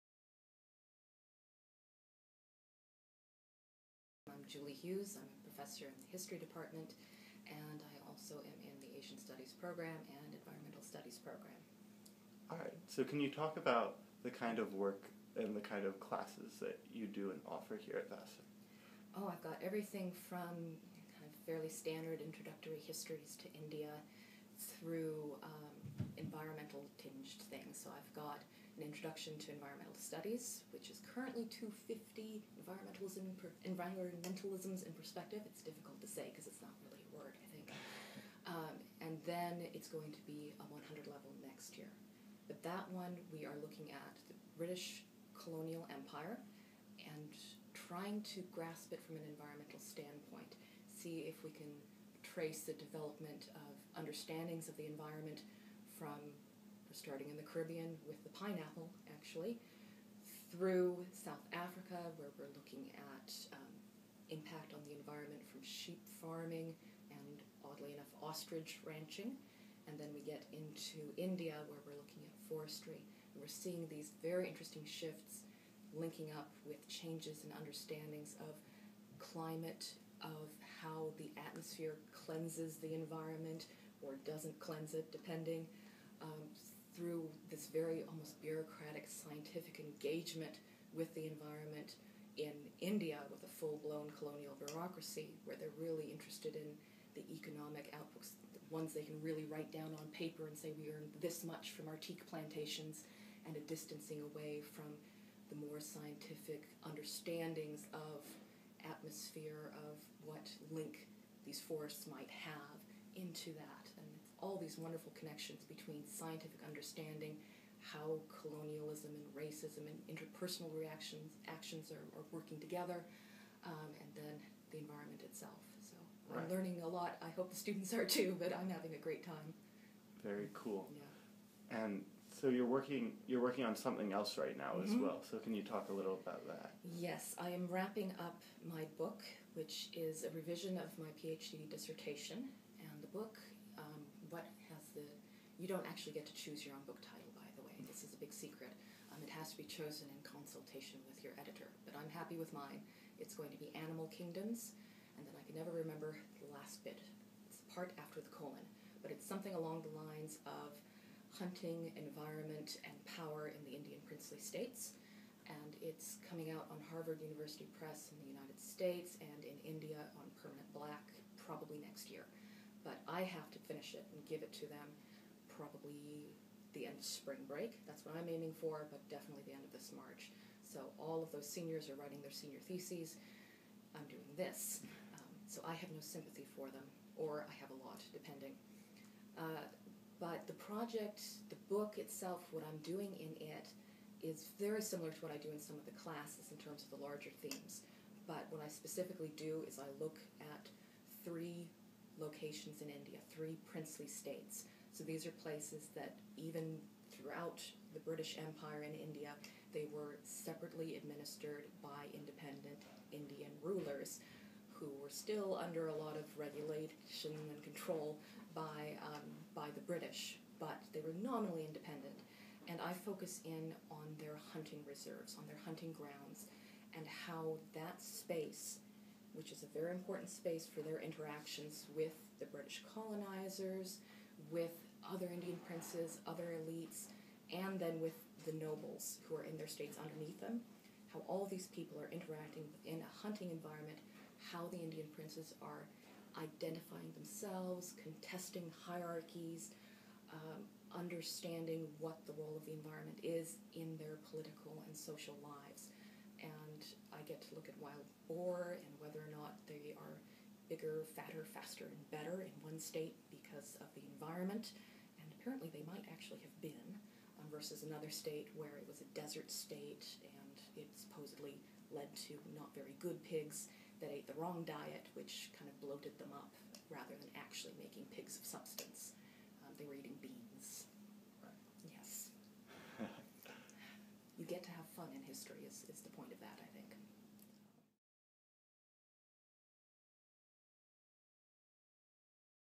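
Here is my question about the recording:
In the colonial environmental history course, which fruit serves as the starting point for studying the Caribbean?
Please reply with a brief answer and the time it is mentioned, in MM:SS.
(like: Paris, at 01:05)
Pineapple, at 00:58.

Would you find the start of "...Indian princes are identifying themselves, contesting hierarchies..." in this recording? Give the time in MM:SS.
04:04.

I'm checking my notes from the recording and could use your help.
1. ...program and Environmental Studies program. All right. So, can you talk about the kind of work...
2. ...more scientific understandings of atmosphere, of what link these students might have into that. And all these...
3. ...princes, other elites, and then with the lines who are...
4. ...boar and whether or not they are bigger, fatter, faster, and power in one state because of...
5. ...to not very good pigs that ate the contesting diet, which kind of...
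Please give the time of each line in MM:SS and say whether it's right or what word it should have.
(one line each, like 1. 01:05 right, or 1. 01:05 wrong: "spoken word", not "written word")
1. 00:09 right
2. 01:45 wrong: "forests", not "students"
3. 03:55 wrong: "nobles", not "lines"
4. 04:18 wrong: "better", not "power"
5. 04:32 wrong: "wrong", not "contesting".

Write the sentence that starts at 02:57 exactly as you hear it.
That's what I'm aiming for, but definitely the end of this March.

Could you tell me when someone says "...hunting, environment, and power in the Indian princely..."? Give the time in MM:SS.
02:41.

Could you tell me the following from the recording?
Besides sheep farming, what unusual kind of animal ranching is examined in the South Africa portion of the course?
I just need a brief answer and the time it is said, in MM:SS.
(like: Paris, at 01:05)
Ostrich ranching, at 01:08.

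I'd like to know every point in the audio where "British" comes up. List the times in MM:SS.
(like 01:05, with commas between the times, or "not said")
00:44, 03:27, 03:39, 03:52.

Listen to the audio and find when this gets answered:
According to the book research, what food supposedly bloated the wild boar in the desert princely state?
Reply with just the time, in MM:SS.
04:40.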